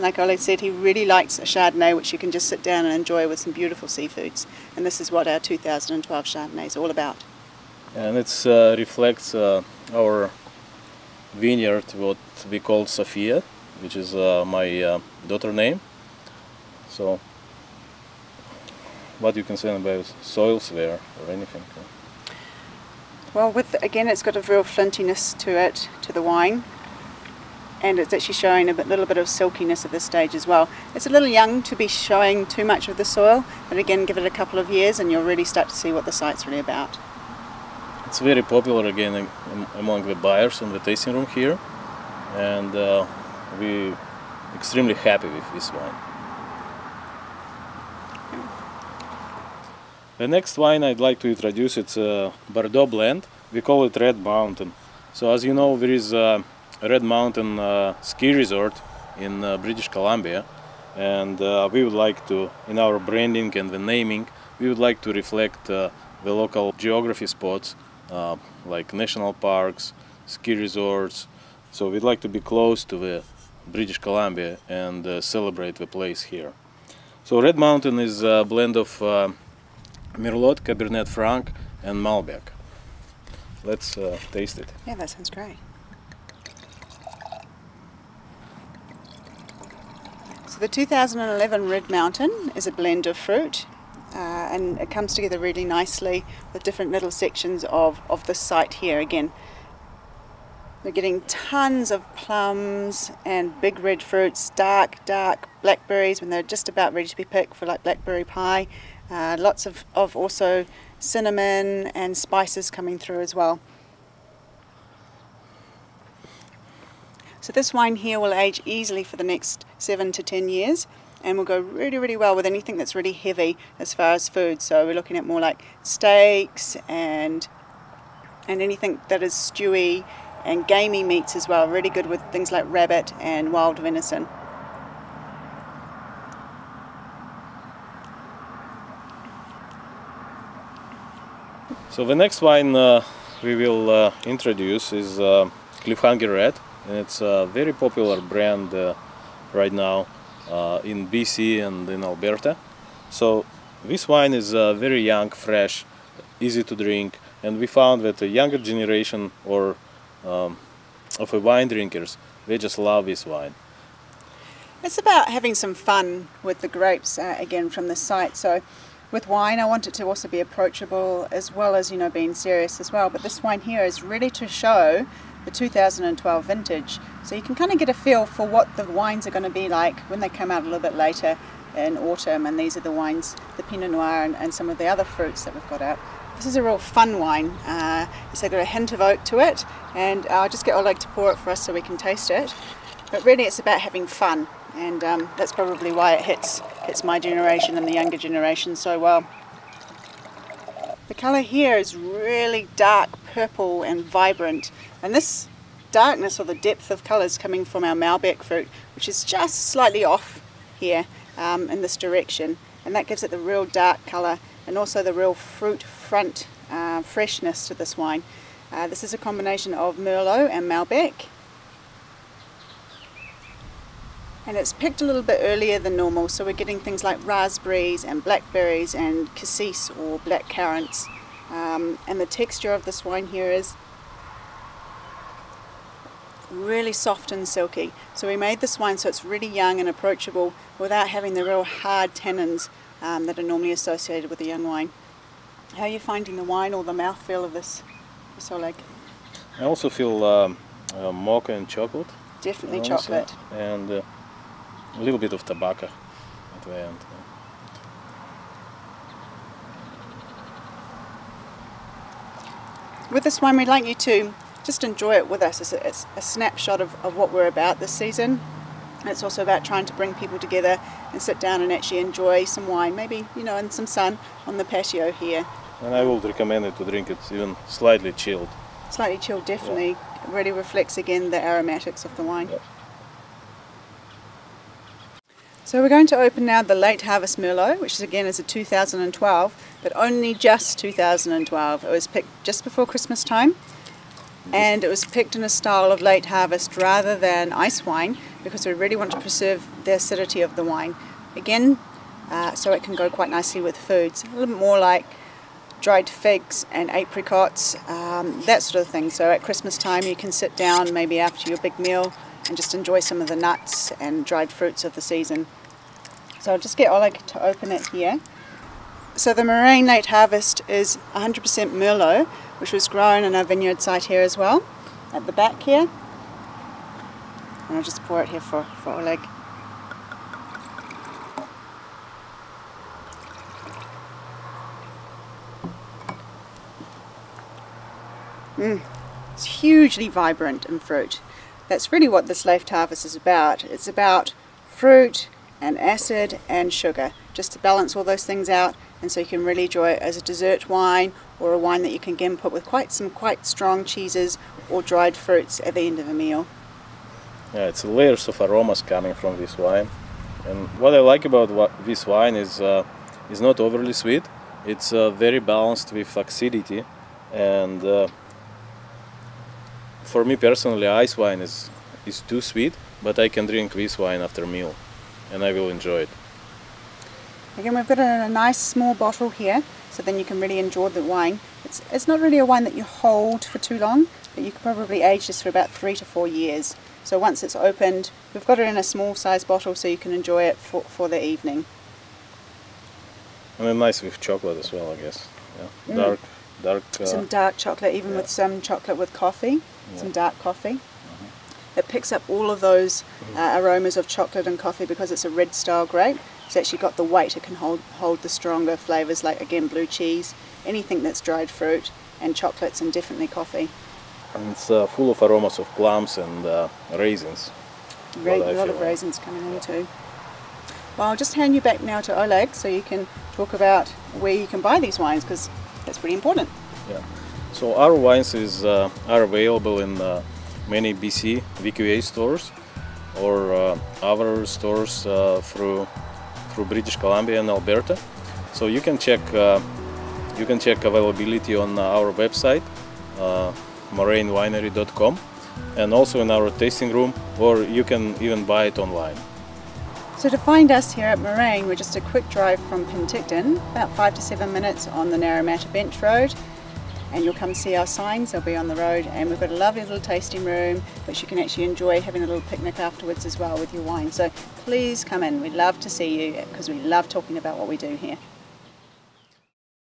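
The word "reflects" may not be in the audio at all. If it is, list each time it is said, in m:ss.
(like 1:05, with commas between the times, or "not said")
0:08, 1:05, 4:40.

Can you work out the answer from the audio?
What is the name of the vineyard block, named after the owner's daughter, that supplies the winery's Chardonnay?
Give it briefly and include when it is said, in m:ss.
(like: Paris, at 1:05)
Sofia, at 0:12.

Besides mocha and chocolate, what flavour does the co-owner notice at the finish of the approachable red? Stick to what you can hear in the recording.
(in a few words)
Tobacco.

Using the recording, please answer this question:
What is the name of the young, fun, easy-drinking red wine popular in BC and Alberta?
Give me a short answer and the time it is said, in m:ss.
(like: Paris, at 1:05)
Cliffhanger Red, at 2:25.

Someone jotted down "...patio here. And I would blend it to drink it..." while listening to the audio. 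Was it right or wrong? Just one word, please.
wrong.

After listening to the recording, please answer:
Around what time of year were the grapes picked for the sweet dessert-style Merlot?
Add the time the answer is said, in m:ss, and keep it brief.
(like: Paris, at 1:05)
Just before Christmas, at 4:52.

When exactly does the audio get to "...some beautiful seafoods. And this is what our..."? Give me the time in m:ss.
0:03.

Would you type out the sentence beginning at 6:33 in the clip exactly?
And mean, nice with chocolate as well, I guess.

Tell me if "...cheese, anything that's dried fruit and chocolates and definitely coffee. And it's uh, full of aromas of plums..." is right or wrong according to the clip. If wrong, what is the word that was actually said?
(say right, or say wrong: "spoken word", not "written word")
right.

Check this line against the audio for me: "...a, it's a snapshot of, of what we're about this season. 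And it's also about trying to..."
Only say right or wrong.
right.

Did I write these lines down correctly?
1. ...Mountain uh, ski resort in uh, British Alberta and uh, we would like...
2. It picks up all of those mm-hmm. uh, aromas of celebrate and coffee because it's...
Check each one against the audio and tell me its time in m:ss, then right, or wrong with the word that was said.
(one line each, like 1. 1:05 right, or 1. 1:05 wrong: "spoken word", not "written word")
1. 0:57 wrong: "Columbia", not "Alberta"
2. 6:41 wrong: "chocolate", not "celebrate".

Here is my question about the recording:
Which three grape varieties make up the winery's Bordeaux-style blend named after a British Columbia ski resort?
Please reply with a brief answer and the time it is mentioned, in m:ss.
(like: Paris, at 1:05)
Merlot, Cabernet Franc and Malbec, at 1:20.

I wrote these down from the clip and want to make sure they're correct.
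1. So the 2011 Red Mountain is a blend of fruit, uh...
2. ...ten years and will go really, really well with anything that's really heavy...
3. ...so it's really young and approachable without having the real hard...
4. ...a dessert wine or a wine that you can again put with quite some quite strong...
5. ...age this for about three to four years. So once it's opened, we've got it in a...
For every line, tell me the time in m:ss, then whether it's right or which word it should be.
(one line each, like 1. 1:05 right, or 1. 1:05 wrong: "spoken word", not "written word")
1. 1:30 right
2. 2:00 right
3. 3:58 right
4. 5:50 right
5. 6:25 right.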